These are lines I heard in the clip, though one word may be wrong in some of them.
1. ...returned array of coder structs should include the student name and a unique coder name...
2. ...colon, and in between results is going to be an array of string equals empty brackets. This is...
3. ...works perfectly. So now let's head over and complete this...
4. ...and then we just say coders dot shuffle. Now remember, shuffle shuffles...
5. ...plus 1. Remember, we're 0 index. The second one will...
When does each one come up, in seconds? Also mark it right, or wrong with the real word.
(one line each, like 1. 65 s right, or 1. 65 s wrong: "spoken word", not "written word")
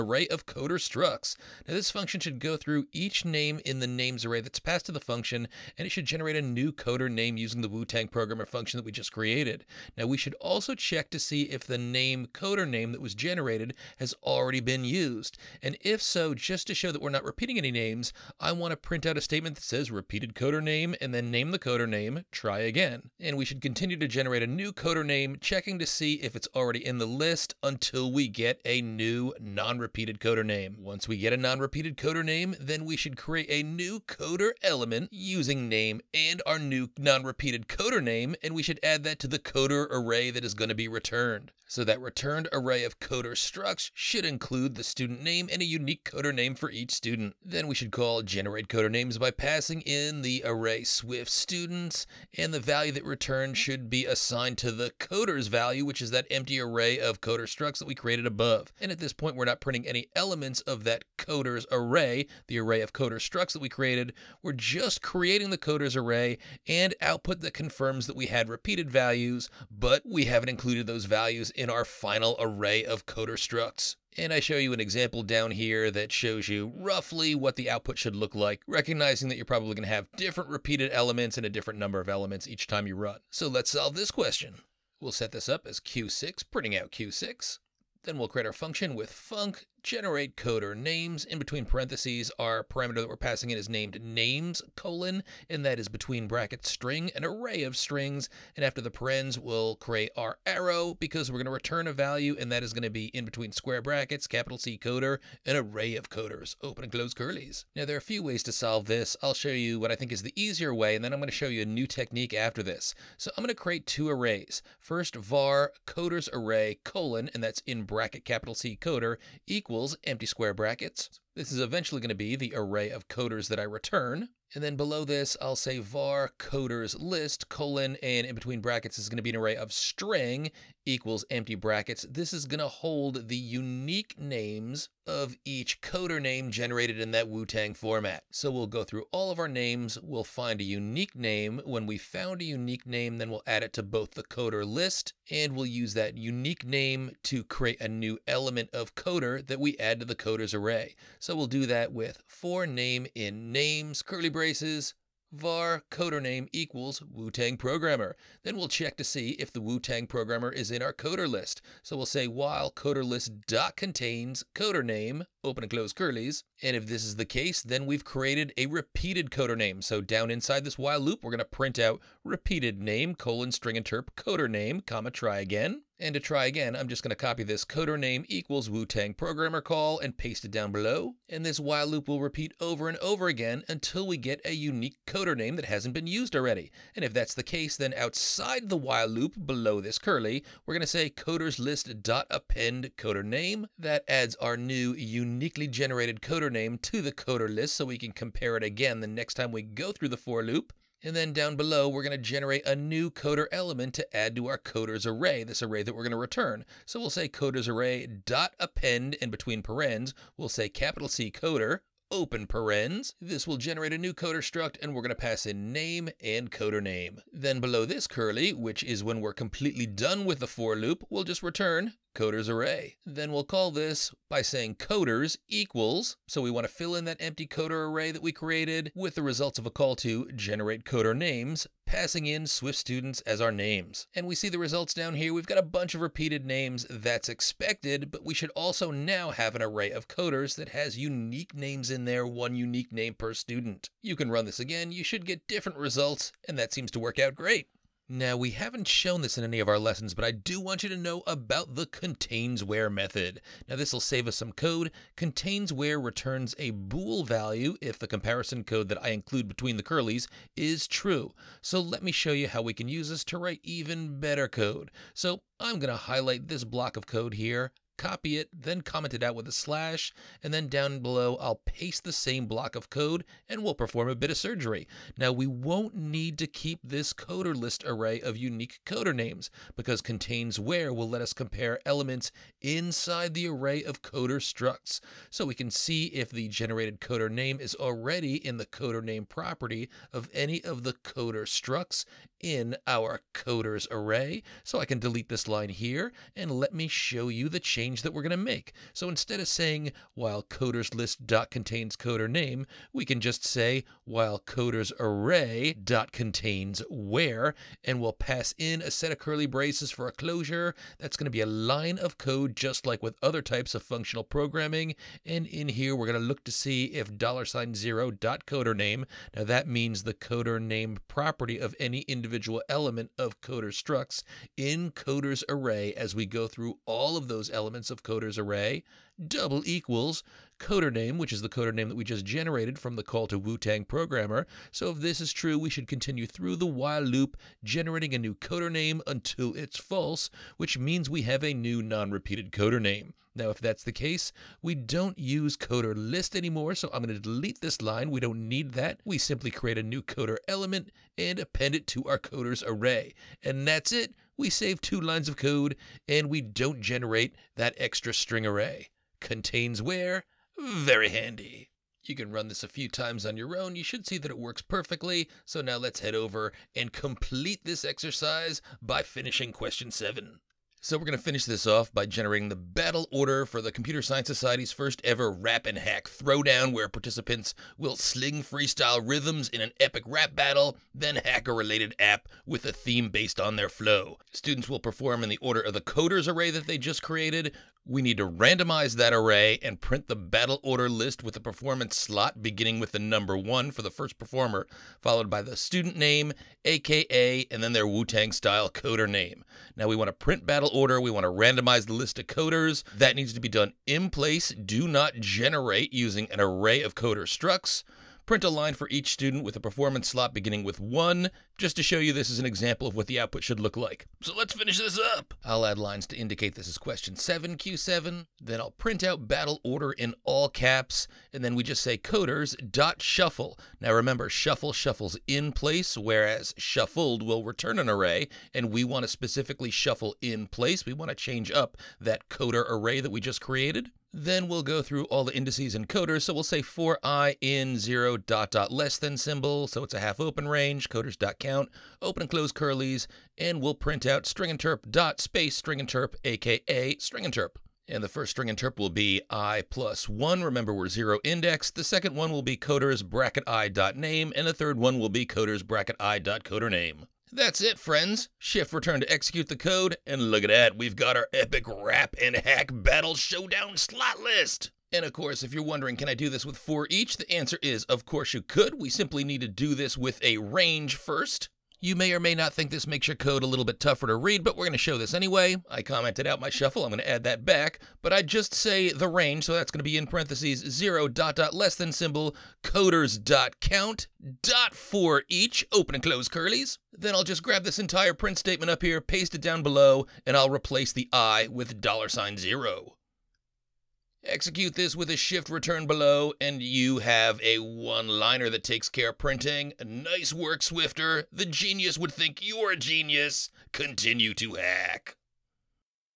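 1. 41 s right
2. 127 s wrong: "brackets", not "results"
3. 364 s right
4. 421 s right
5. 449 s right.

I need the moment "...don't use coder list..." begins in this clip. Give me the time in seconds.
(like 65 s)
344 s.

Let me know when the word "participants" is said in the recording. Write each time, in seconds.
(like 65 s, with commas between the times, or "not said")
376 s.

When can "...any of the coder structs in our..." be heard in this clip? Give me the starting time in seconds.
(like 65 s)
290 s.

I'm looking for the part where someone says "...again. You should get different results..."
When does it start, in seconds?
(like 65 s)
244 s.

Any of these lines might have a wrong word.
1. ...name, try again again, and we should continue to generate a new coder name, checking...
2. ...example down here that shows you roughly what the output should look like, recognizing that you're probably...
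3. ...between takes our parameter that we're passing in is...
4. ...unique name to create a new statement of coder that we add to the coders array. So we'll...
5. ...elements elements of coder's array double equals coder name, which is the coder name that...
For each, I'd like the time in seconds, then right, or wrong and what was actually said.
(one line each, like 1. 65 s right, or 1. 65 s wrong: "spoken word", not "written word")
1. 21 s right
2. 74 s right
3. 91 s wrong: "parentheses", not "takes"
4. 146 s wrong: "element", not "statement"
5. 327 s right.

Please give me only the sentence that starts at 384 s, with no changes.
Students will perform in the order of the coders array that they just created.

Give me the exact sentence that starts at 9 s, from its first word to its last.
Now we should also check to see if the name coder name that was generated has already been used.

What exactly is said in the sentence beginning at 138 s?
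So we'll go through all of our names.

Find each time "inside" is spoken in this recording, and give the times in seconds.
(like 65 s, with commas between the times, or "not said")
170 s, 282 s.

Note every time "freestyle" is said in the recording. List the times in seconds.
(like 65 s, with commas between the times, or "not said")
378 s.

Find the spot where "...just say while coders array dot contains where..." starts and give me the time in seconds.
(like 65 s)
303 s.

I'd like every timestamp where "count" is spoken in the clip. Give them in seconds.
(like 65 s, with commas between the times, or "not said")
441 s, 483 s.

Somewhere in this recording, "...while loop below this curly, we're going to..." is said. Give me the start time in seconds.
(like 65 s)
188 s.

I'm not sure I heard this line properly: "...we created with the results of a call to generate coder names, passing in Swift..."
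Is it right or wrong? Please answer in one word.
right.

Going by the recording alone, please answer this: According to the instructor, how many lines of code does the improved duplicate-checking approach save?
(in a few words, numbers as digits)
2.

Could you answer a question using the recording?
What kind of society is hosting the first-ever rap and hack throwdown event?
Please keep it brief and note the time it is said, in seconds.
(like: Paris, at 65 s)
Computer Science Society, at 373 s.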